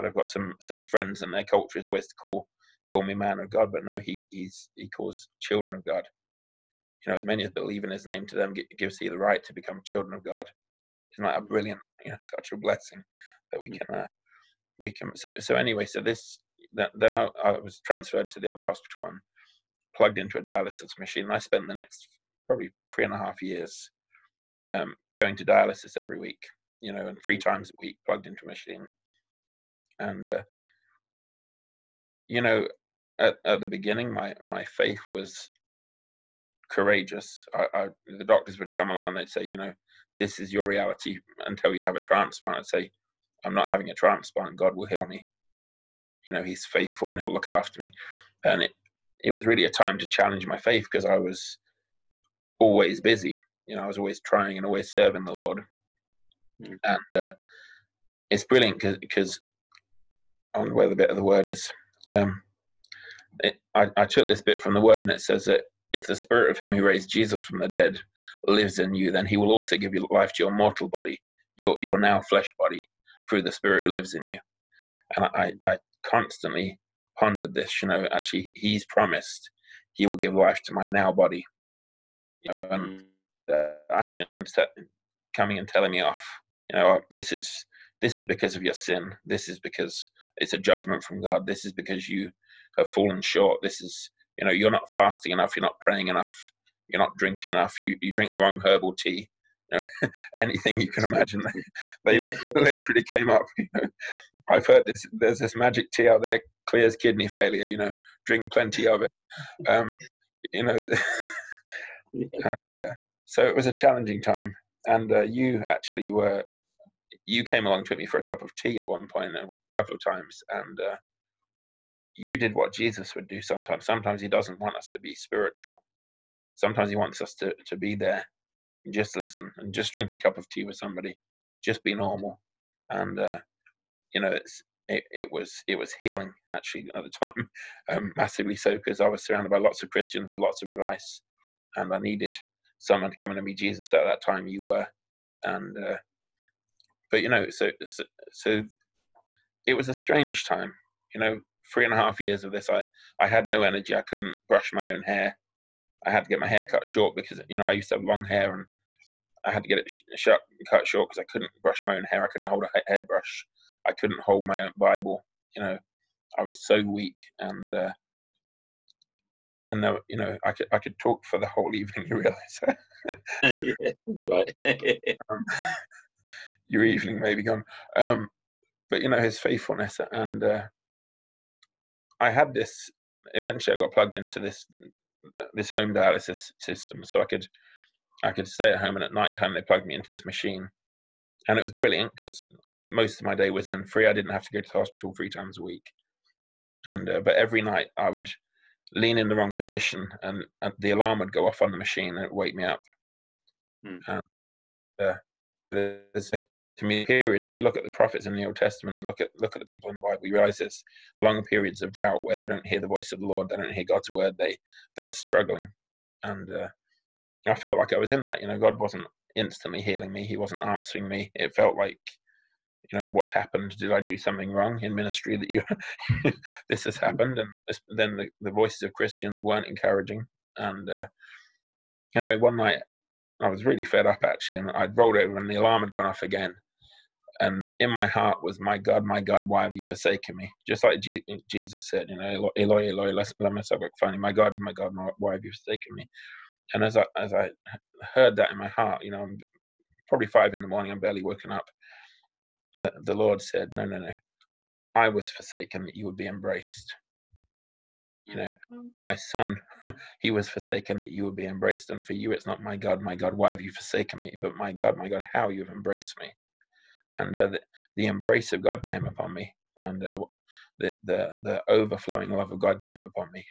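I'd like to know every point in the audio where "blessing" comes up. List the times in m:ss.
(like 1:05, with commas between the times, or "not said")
0:12.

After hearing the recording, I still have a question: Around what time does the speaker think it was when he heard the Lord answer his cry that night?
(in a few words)
5 in the morning.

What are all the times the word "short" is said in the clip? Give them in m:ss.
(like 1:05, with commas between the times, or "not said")
1:33, 2:36, 2:40.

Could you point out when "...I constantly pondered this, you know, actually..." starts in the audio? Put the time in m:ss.
1:15.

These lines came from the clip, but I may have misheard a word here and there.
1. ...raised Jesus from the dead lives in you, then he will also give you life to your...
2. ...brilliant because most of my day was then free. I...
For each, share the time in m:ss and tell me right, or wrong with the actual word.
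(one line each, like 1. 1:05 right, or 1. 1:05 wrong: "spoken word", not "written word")
1. 1:06 right
2. 3:11 right.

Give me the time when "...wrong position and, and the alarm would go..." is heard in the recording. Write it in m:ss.
3:19.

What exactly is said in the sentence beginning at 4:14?
I was forsaken that you would be embraced.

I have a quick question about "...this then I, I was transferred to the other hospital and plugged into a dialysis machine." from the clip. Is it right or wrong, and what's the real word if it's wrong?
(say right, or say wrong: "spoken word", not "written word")
right.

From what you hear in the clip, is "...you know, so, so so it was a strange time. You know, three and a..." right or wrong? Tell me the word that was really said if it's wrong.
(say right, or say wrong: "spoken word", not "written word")
right.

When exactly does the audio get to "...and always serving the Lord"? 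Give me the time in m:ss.
0:54.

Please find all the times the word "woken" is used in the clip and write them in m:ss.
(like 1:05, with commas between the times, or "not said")
4:11.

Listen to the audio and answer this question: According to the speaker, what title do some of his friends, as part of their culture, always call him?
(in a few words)
man of God.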